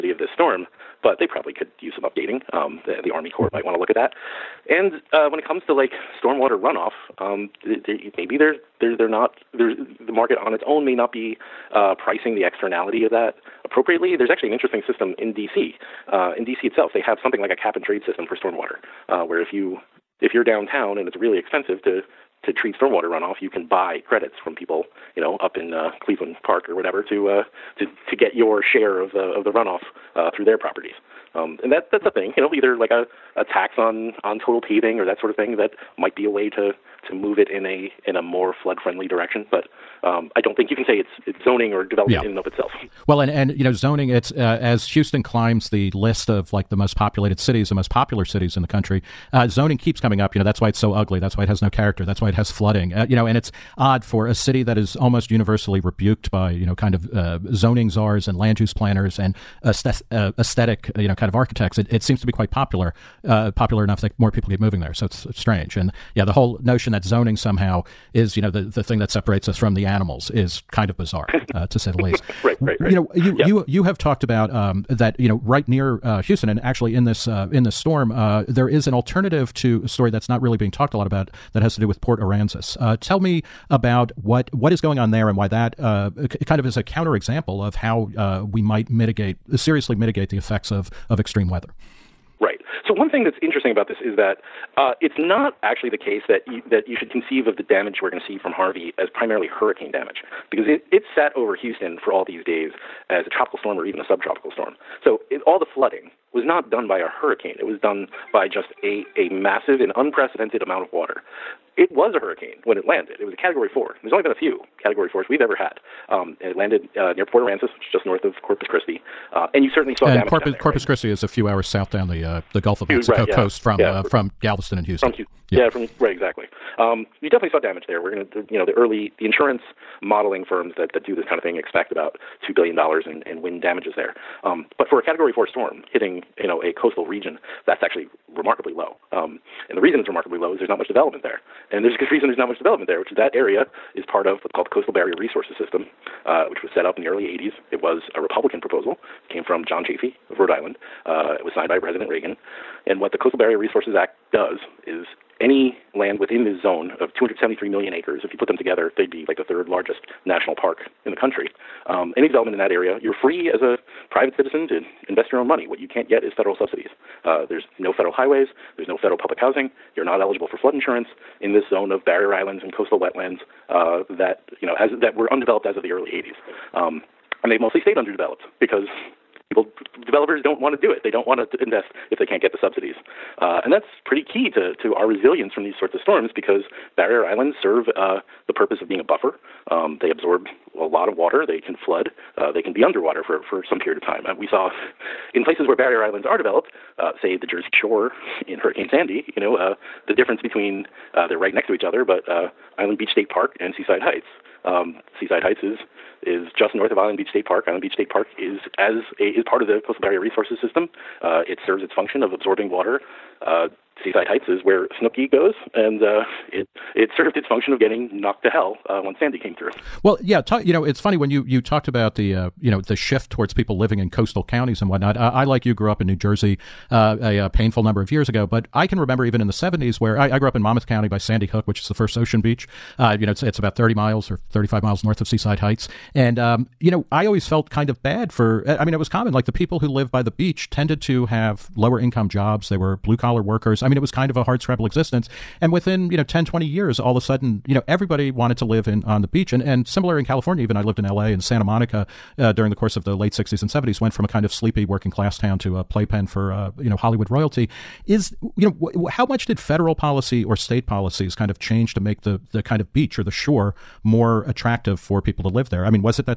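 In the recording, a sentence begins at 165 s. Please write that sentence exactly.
What you can't get is federal subsidies.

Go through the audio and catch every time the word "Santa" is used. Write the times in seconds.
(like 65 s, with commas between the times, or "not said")
251 s.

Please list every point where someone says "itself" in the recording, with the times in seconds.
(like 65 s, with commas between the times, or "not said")
16 s, 42 s.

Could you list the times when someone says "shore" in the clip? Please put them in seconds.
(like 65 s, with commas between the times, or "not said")
197 s, 263 s.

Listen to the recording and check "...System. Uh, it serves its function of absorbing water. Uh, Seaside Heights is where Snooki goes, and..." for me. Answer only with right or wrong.
right.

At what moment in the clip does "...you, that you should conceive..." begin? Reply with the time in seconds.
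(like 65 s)
96 s.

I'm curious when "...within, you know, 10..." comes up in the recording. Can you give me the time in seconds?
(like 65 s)
245 s.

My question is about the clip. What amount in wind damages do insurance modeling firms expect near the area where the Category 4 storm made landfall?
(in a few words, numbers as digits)
$2 billion.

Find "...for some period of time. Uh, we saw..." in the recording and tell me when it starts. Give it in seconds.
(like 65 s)
193 s.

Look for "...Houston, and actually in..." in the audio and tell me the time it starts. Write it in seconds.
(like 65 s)
76 s.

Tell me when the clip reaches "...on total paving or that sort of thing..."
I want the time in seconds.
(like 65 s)
34 s.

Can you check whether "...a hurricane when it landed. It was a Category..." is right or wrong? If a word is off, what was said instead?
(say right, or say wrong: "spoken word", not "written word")
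right.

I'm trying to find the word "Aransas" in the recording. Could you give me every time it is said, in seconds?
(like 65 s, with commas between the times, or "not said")
82 s, 117 s.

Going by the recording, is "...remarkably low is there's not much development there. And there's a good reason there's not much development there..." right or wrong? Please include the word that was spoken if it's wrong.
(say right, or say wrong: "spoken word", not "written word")
right.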